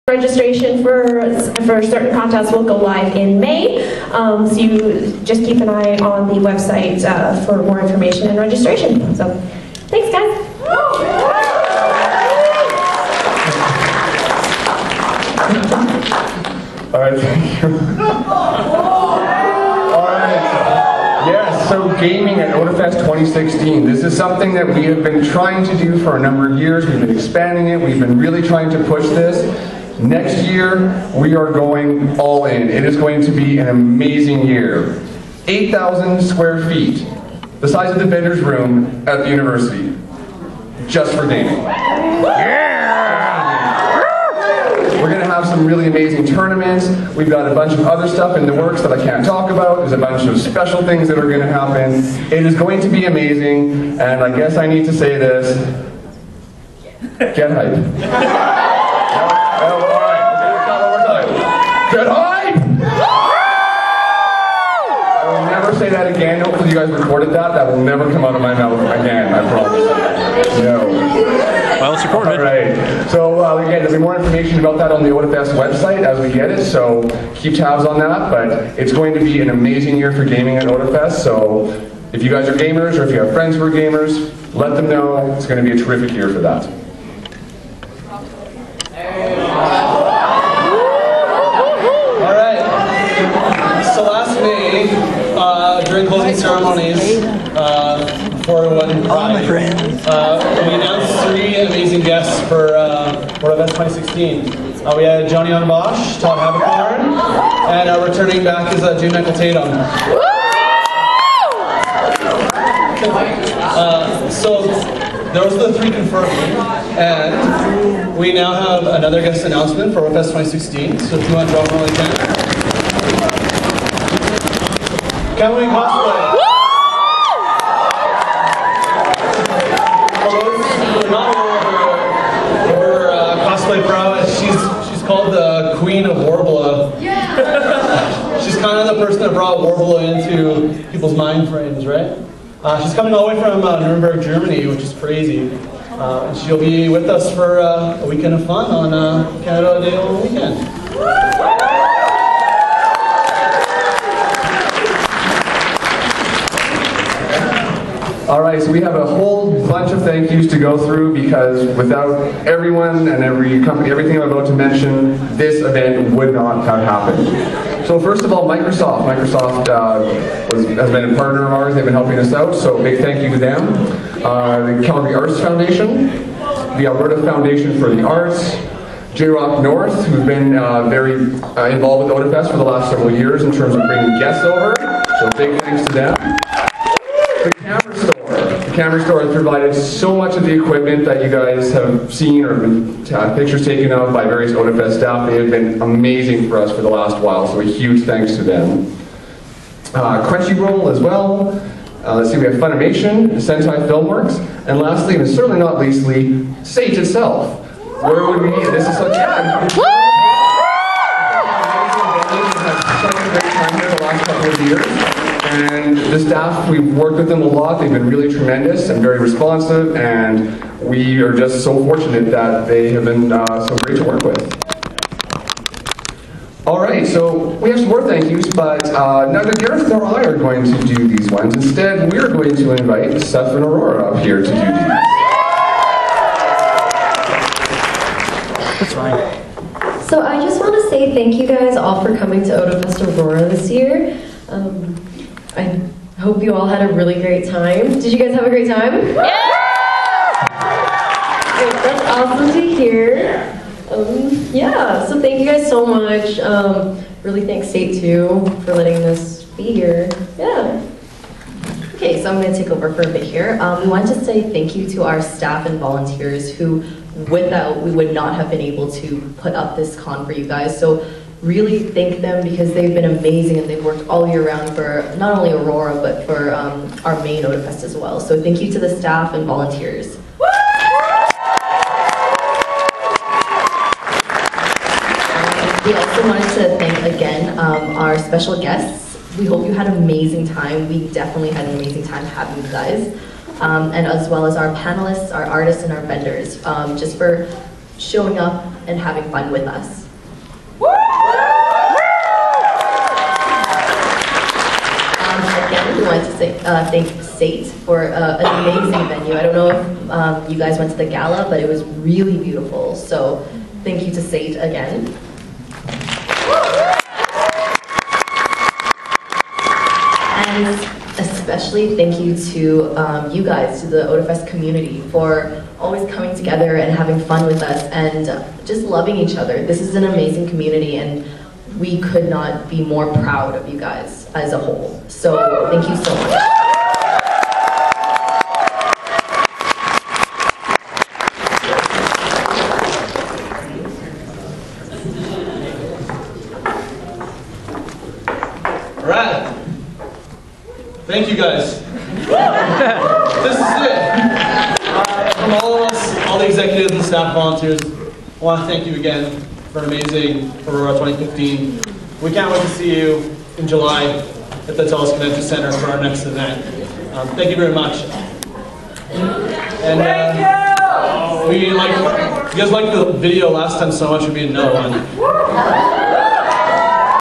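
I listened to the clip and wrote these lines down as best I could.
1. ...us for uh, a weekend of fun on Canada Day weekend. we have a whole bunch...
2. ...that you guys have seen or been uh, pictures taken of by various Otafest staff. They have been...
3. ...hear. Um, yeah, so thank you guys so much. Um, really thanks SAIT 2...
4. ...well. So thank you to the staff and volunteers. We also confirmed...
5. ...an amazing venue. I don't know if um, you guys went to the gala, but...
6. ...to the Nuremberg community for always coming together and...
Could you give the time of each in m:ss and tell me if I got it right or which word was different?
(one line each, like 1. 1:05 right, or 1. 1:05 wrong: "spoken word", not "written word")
1. 2:27 right
2. 3:11 right
3. 4:12 right
4. 4:37 wrong: "wanted", not "confirmed"
5. 5:08 right
6. 5:23 wrong: "Otafest", not "Nuremberg".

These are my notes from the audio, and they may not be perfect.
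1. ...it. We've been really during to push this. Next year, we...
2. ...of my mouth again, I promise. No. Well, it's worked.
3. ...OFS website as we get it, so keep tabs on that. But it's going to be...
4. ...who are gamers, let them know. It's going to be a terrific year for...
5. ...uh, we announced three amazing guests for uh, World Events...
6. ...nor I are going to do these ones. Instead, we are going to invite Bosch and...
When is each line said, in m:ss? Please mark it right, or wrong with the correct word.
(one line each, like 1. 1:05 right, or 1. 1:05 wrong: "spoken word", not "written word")
1. 0:27 wrong: "trying", not "during"
2. 1:08 wrong: "recorded", not "worked"
3. 1:15 right
4. 1:23 right
5. 1:40 right
6. 3:49 wrong: "Seth", not "Bosch".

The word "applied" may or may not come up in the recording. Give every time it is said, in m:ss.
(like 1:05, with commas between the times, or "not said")
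not said.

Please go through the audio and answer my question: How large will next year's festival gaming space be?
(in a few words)
8,000 square feet.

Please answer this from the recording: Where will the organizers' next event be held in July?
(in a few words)
TELUS Convention Center.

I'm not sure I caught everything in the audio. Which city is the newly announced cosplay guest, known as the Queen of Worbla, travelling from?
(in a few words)
Nuremberg, Germany.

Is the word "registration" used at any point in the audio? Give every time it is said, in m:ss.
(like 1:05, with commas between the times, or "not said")
0:00, 0:08.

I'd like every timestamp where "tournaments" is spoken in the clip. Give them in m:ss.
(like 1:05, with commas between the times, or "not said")
0:46.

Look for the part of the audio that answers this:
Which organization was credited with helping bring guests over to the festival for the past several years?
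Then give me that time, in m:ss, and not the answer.
2:59.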